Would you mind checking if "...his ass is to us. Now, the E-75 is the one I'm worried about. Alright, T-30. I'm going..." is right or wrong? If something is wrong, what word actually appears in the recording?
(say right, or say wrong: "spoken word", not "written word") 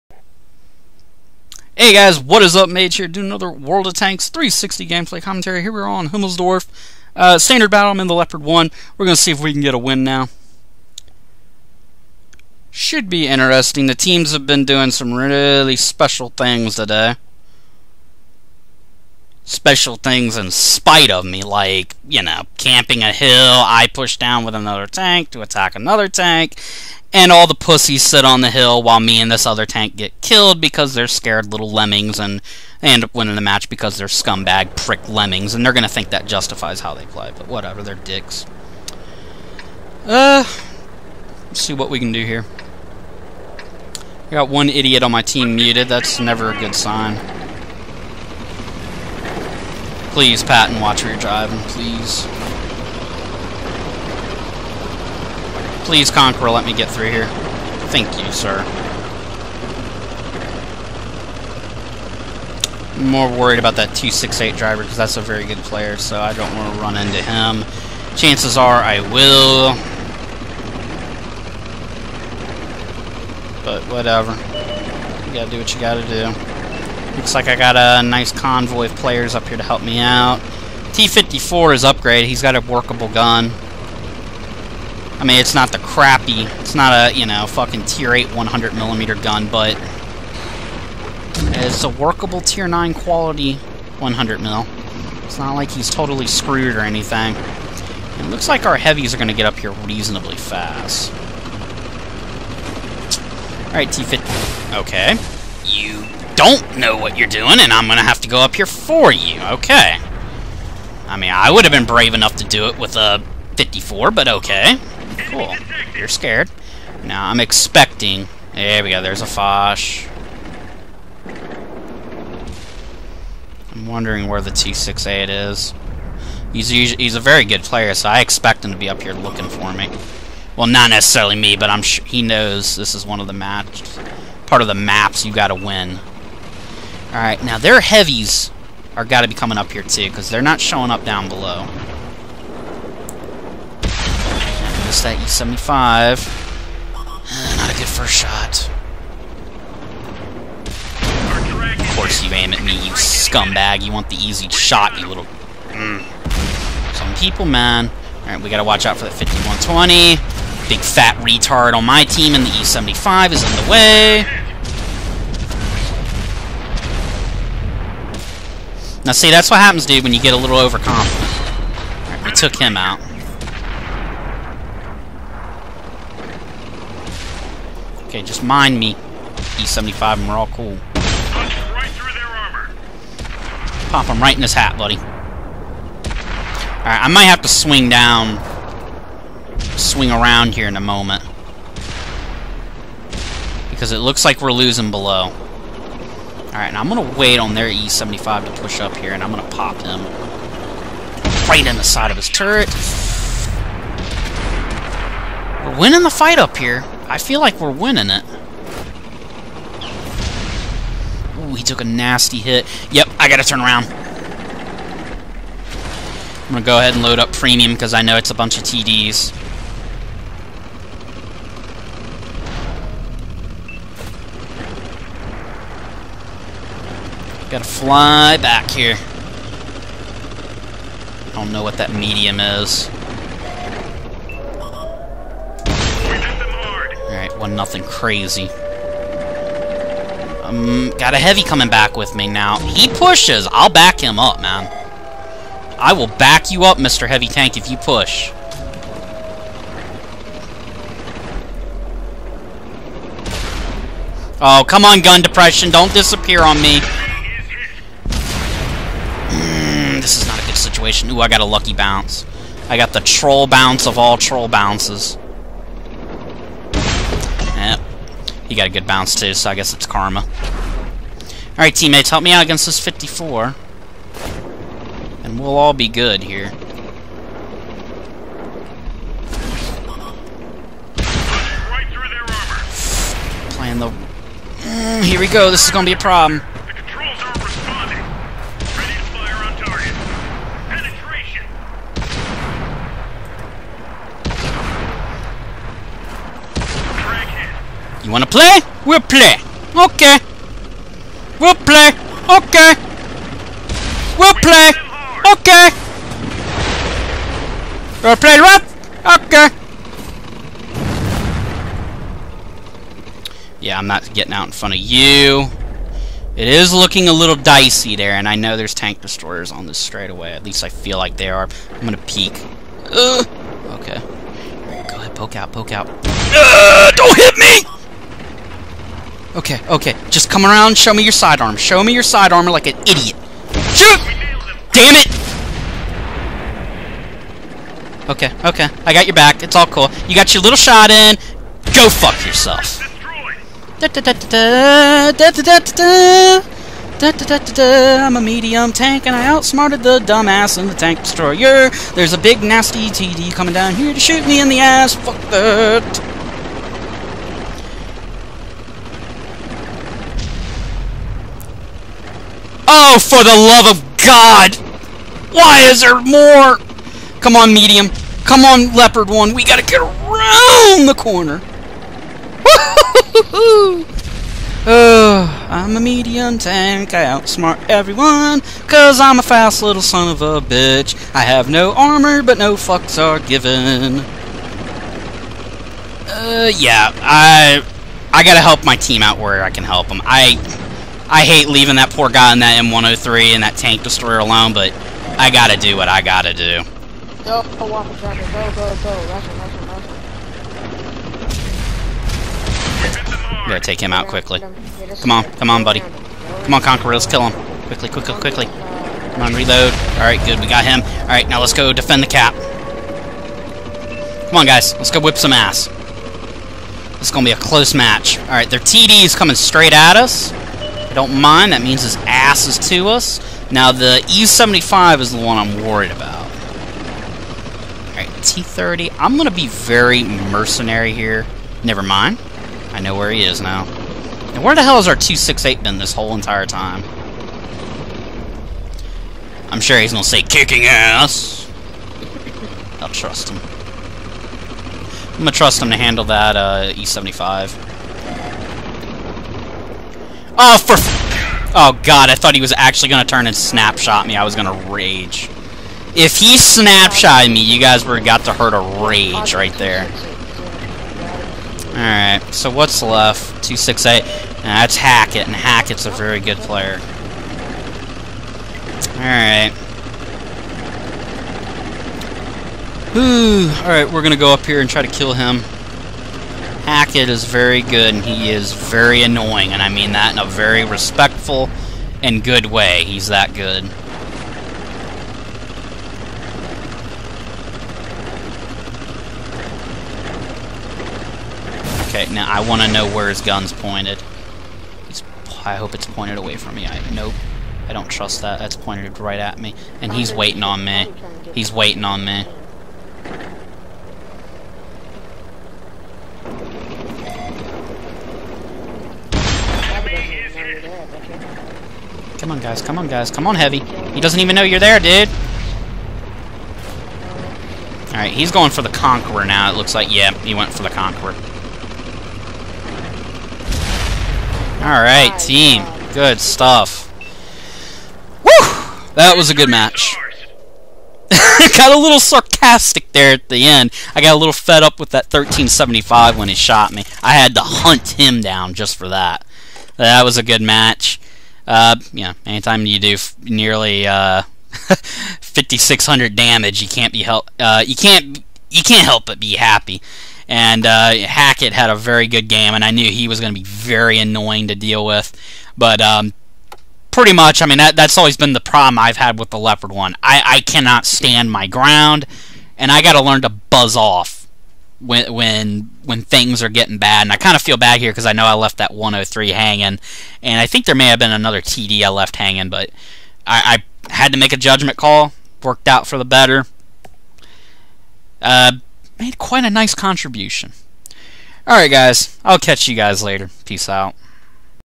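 right.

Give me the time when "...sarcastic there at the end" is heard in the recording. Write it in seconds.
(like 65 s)
531 s.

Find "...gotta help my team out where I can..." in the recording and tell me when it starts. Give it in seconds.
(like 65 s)
388 s.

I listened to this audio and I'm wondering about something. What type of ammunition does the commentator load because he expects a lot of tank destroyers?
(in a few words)
premium.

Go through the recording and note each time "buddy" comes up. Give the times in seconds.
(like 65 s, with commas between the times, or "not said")
184 s, 405 s.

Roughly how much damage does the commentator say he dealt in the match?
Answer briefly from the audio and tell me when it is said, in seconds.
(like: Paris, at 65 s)
5,600, at 544 s.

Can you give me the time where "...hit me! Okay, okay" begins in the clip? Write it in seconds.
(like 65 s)
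327 s.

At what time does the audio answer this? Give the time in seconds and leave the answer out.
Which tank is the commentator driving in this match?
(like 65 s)
8 s.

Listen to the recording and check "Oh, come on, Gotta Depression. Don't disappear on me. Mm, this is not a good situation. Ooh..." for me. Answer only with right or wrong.
wrong.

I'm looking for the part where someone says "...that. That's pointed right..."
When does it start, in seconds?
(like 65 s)
498 s.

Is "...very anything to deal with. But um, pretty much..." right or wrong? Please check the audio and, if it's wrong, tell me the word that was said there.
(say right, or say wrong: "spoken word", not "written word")
wrong: "annoying", not "anything".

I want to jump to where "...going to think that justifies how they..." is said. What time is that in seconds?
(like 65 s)
35 s.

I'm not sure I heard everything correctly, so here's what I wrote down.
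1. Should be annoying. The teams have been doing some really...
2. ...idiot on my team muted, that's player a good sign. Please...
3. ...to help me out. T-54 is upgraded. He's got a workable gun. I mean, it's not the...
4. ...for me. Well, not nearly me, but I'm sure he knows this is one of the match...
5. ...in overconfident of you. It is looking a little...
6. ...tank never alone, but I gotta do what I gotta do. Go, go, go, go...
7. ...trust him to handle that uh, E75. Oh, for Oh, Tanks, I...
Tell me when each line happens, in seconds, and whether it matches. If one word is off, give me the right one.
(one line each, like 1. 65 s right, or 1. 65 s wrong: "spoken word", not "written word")
1. 12 s wrong: "interesting", not "annoying"
2. 44 s wrong: "never", not "player"
3. 79 s right
4. 129 s wrong: "necessarily", not "nearly"
5. 314 s wrong: "front", not "overconfident"
6. 393 s wrong: "destroyer", not "never"
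7. 445 s wrong: "God", not "Tanks".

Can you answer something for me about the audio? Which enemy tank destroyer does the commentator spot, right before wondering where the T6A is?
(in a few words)
Foch.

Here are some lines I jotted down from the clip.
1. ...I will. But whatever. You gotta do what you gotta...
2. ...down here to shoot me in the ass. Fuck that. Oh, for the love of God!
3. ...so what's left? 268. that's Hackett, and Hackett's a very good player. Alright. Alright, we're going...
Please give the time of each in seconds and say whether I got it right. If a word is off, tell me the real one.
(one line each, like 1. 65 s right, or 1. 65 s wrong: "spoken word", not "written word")
1. 68 s right
2. 353 s right
3. 462 s right.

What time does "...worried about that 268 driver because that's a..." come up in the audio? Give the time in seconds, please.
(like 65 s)
63 s.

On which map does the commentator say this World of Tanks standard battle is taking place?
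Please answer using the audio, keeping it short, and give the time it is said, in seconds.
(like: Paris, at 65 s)
Himmelsdorf, at 6 s.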